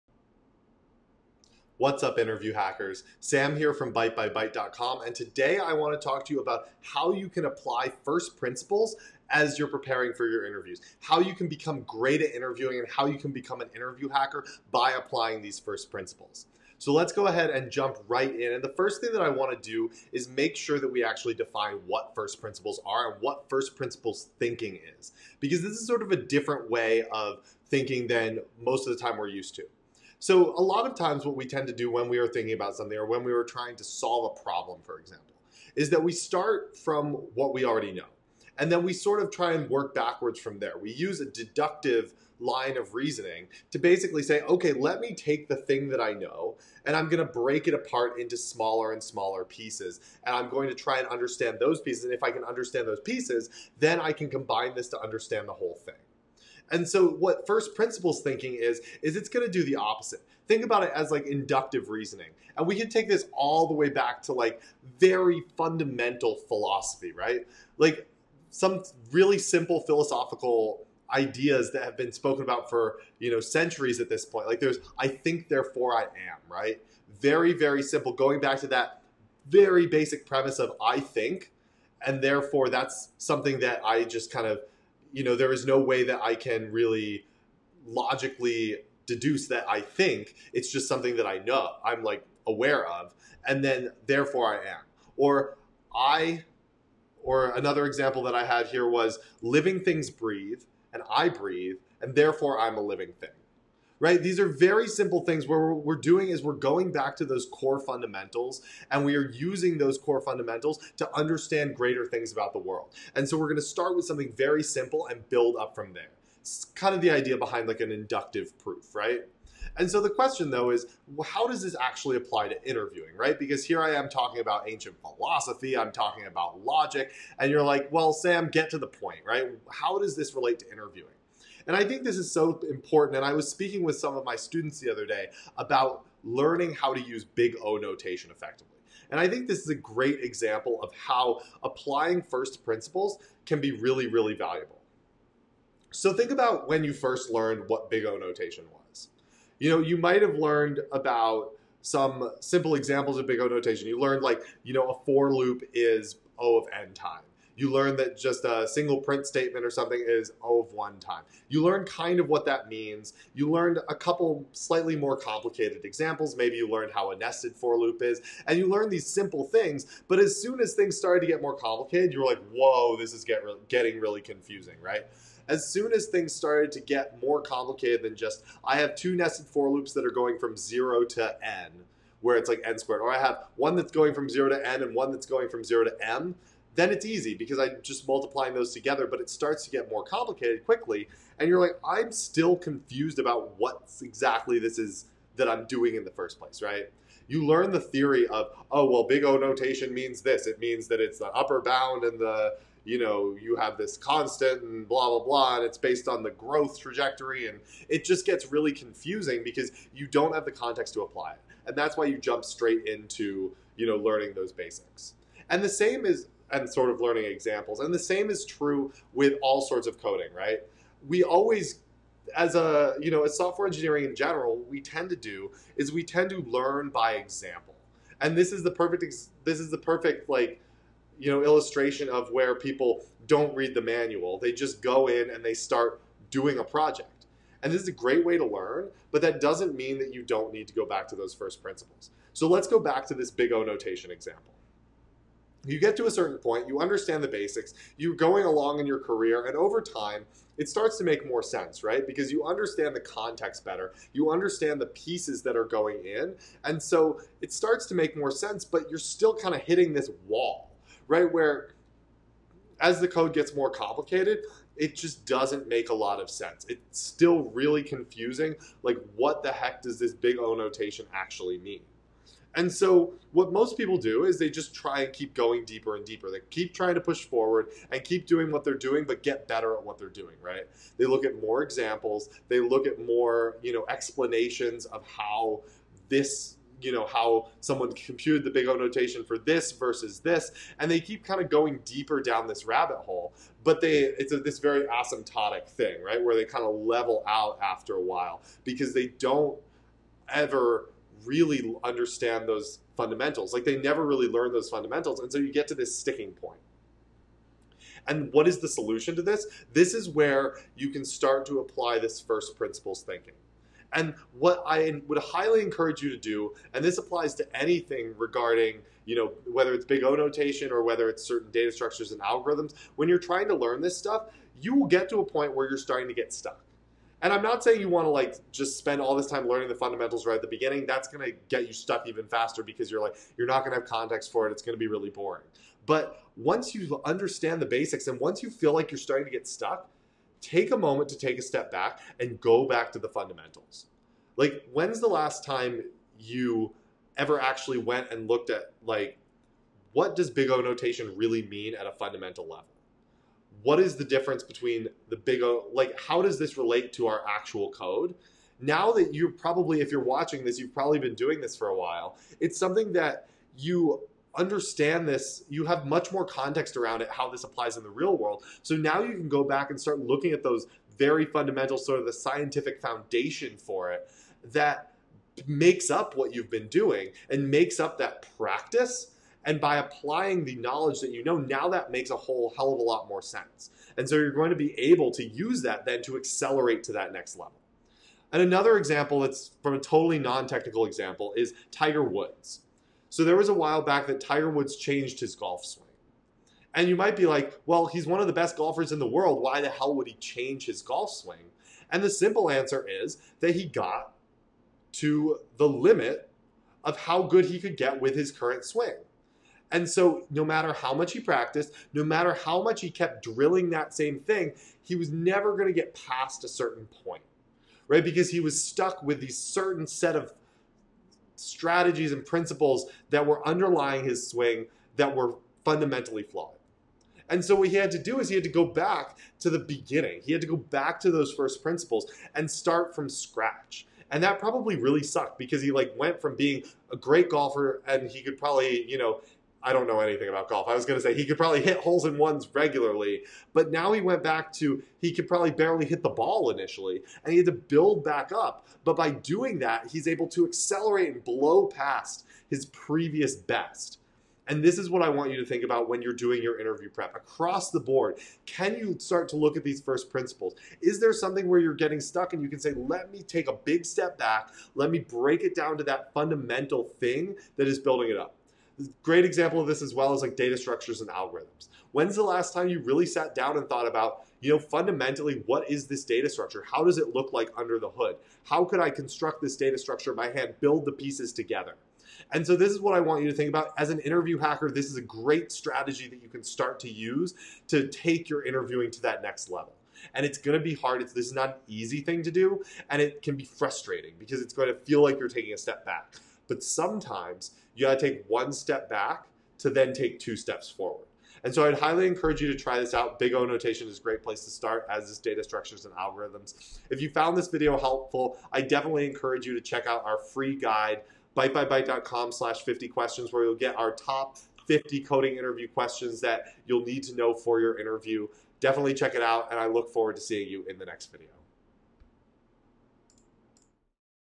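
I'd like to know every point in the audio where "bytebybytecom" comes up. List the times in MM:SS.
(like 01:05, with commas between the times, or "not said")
00:03, 08:31.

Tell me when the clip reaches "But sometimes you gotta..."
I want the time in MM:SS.
08:16.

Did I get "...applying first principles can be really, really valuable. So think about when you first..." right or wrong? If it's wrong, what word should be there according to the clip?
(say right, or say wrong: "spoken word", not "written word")
right.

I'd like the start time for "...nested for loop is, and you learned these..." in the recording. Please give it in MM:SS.
02:47.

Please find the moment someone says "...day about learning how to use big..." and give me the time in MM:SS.
02:15.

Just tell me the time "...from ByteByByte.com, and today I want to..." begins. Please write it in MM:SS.
00:03.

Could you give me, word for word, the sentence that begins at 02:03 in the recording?
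Because here I am talking about ancient philosophy, I'm talking about logic, and you're like, well, Sam, get to the point, right?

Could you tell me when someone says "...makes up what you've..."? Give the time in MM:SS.
06:15.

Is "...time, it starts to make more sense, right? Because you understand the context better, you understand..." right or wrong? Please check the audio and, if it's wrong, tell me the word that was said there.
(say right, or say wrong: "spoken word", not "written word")
right.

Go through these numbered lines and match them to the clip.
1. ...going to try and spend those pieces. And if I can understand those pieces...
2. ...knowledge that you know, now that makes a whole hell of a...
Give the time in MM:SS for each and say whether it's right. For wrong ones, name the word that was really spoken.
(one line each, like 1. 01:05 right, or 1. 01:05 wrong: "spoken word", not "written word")
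1. 00:50 wrong: "understand", not "spend"
2. 06:20 right.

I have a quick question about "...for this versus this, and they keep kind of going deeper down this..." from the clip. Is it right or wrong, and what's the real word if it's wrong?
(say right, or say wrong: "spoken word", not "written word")
right.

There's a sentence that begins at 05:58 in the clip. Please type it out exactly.
Now that you are probably, if you're watching this, you've probably been doing this for a while.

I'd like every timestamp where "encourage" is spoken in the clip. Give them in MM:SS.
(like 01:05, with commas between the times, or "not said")
05:15, 08:22, 08:29.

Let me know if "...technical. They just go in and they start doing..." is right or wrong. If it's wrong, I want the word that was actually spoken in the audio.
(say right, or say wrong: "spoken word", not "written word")
wrong: "manual", not "technical".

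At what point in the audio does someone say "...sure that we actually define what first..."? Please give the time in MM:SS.
00:20.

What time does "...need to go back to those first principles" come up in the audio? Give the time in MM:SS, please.
04:00.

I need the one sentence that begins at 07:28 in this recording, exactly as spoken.
But by doing that, he's able to accelerate and blow past his previous best.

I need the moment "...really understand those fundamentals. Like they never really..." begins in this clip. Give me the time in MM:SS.
05:01.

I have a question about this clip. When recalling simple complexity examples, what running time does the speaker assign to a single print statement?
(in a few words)
O of one.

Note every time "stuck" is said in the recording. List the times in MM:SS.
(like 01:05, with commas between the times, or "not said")
05:26, 05:31, 05:39, 06:58, 07:42.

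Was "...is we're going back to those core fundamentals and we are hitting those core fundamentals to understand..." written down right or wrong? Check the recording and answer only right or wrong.
wrong.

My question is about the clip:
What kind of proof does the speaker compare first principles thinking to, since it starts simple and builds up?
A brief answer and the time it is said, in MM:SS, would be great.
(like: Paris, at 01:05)
inductive proof, at 01:57.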